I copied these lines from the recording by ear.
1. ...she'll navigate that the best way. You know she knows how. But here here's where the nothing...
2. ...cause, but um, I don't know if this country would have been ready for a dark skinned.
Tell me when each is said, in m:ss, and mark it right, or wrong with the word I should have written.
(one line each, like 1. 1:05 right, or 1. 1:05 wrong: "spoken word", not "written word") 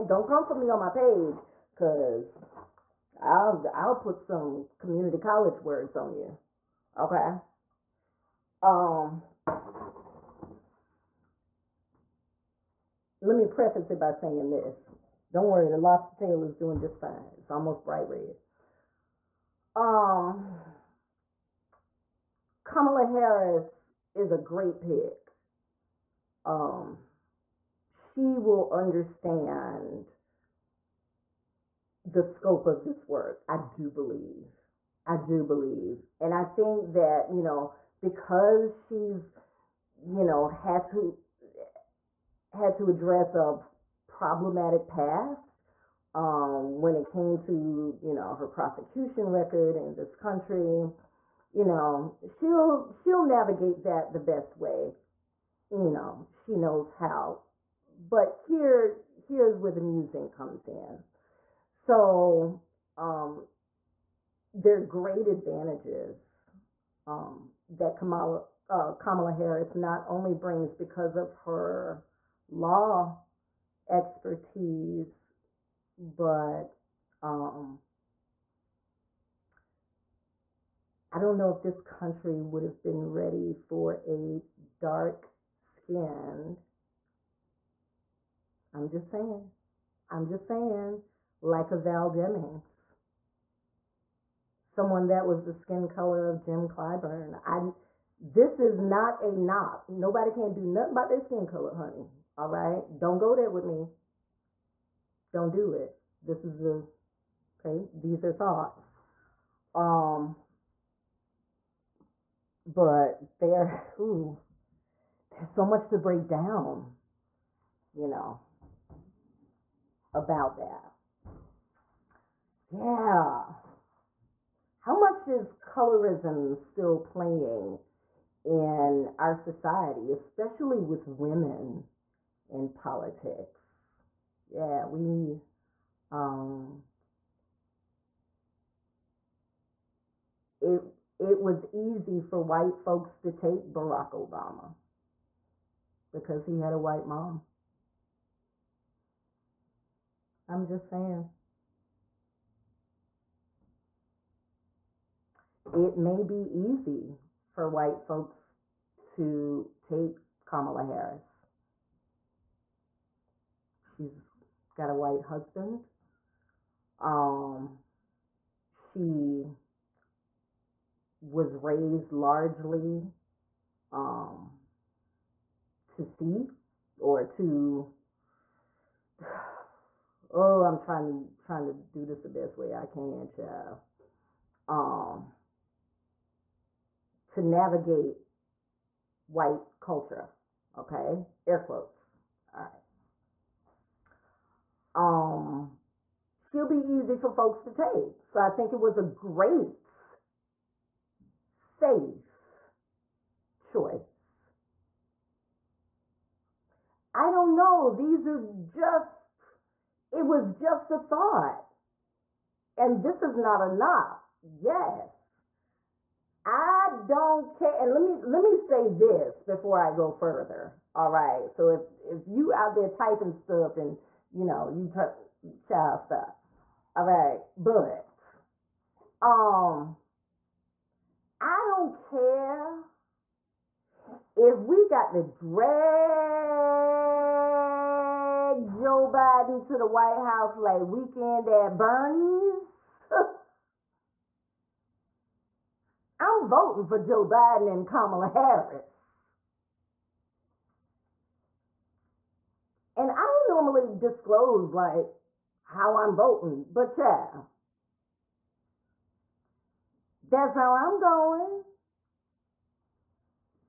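1. 0:52 wrong: "musing", not "nothing"
2. 1:13 wrong: "expertise", not "cause".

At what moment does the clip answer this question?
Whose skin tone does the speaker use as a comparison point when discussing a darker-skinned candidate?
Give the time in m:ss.
1:36.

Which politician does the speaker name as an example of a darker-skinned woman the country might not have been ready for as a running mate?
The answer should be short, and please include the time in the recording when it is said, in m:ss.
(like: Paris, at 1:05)
Val Demings, at 1:31.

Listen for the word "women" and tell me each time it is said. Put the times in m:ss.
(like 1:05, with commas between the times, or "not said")
2:11.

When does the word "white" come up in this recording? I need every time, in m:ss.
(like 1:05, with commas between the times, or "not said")
2:22, 2:26, 2:37, 2:44, 3:09, 3:59.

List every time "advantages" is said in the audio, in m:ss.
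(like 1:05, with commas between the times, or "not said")
1:05.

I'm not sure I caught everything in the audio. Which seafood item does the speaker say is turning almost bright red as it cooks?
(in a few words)
lobster tail.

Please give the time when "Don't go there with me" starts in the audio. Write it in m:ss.
1:42.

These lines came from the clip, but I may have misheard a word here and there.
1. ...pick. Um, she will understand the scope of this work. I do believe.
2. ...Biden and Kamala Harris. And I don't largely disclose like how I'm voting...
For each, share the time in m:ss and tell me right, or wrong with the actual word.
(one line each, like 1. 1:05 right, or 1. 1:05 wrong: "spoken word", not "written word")
1. 0:24 right
2. 4:07 wrong: "normally", not "largely".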